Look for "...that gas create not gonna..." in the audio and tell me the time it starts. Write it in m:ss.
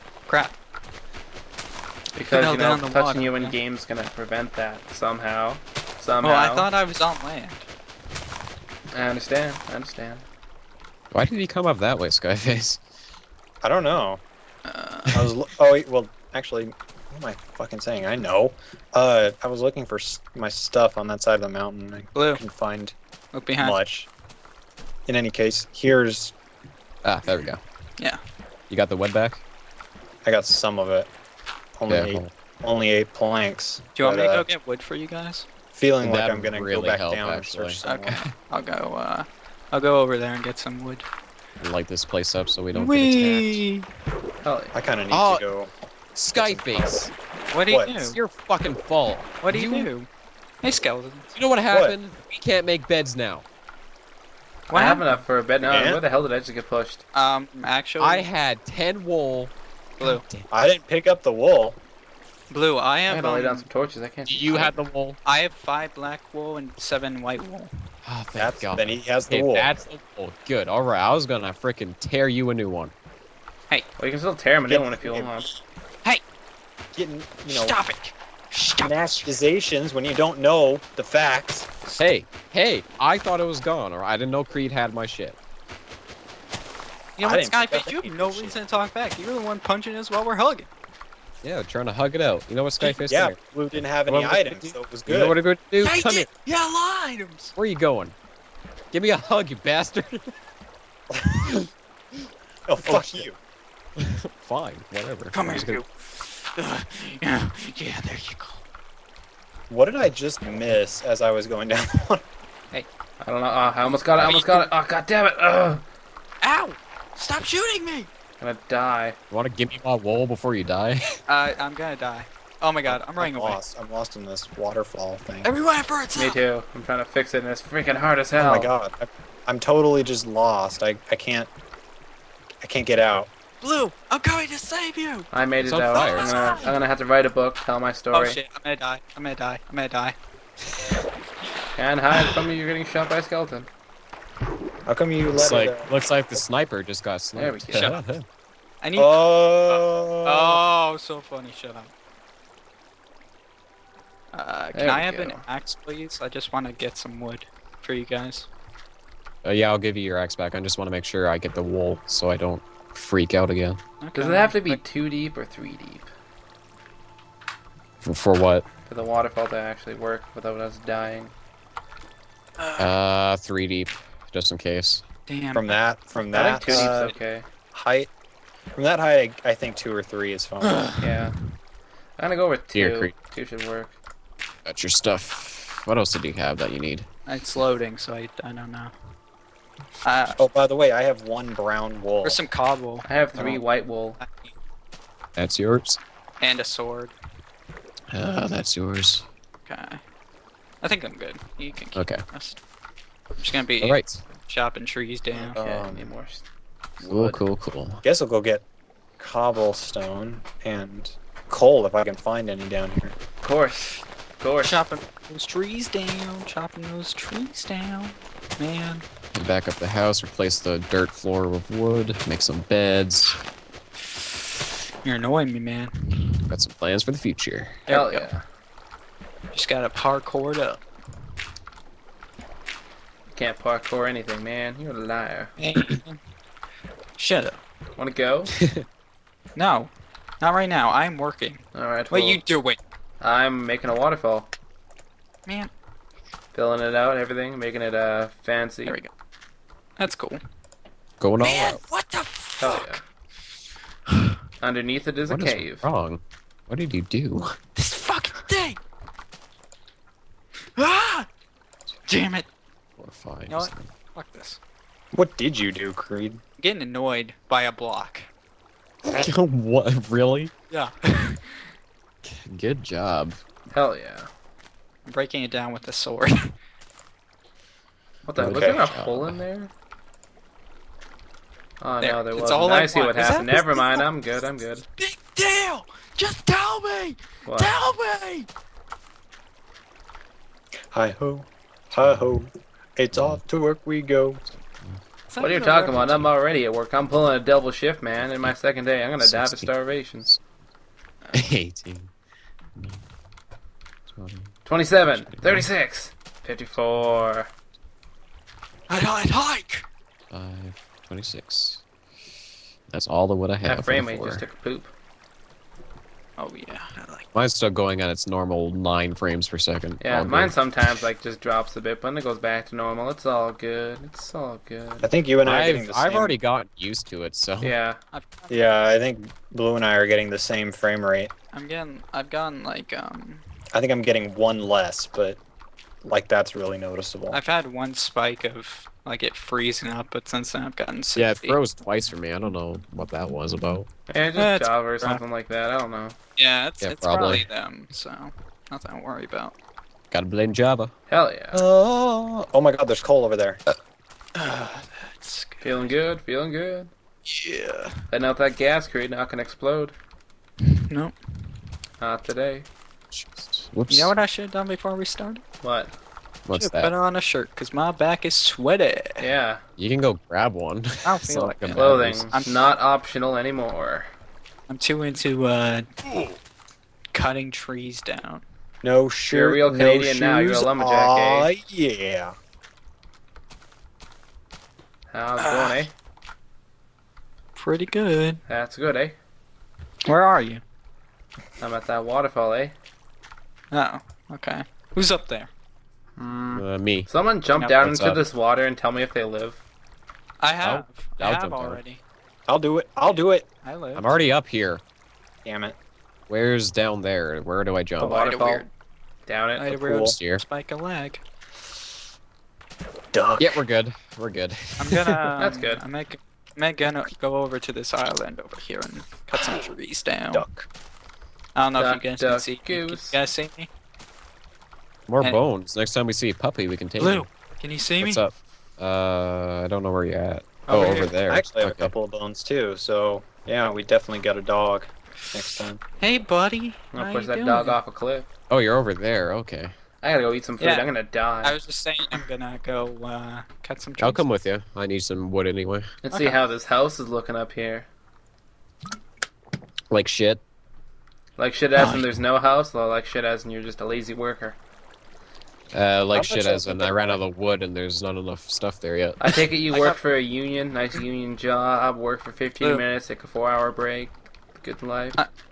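5:58.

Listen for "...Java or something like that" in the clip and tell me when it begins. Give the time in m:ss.
5:44.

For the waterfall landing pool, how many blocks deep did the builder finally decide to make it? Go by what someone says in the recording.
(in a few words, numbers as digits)
2.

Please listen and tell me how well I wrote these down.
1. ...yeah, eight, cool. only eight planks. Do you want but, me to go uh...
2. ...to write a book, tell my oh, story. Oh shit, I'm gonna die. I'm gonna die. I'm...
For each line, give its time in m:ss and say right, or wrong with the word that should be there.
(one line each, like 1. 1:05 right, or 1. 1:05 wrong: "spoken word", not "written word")
1. 0:31 right
2. 2:16 right.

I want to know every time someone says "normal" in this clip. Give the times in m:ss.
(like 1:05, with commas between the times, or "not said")
5:18, 5:22.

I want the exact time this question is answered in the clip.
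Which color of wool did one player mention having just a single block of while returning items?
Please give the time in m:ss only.
3:11.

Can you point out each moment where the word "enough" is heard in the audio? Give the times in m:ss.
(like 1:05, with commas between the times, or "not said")
0:55, 7:38.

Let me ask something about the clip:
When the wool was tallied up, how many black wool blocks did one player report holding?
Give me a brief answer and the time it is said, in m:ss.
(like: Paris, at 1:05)
5, at 1:05.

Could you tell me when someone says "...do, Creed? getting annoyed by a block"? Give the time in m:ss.
4:25.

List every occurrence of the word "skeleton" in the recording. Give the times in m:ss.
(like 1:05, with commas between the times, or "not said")
0:50, 2:23.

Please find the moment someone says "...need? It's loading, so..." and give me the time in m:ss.
3:06.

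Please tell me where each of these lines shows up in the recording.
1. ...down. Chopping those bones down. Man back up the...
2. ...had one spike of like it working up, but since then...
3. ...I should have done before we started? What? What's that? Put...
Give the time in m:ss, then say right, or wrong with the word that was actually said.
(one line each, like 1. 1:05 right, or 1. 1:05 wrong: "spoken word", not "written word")
1. 3:35 wrong: "trees", not "bones"
2. 5:37 wrong: "freezing", not "working"
3. 6:04 right.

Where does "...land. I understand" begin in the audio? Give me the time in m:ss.
0:07.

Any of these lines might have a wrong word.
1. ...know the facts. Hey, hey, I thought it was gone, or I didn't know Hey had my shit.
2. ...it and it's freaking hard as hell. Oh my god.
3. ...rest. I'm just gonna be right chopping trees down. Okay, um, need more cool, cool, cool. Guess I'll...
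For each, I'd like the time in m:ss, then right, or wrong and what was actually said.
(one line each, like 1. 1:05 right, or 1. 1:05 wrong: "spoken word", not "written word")
1. 1:20 wrong: "Creed", not "Hey"
2. 2:07 right
3. 3:22 right.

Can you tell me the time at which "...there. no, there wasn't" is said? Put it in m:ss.
4:41.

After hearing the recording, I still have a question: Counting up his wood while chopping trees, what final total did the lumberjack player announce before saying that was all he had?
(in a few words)
26.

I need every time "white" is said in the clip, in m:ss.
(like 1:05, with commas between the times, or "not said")
1:07, 3:13.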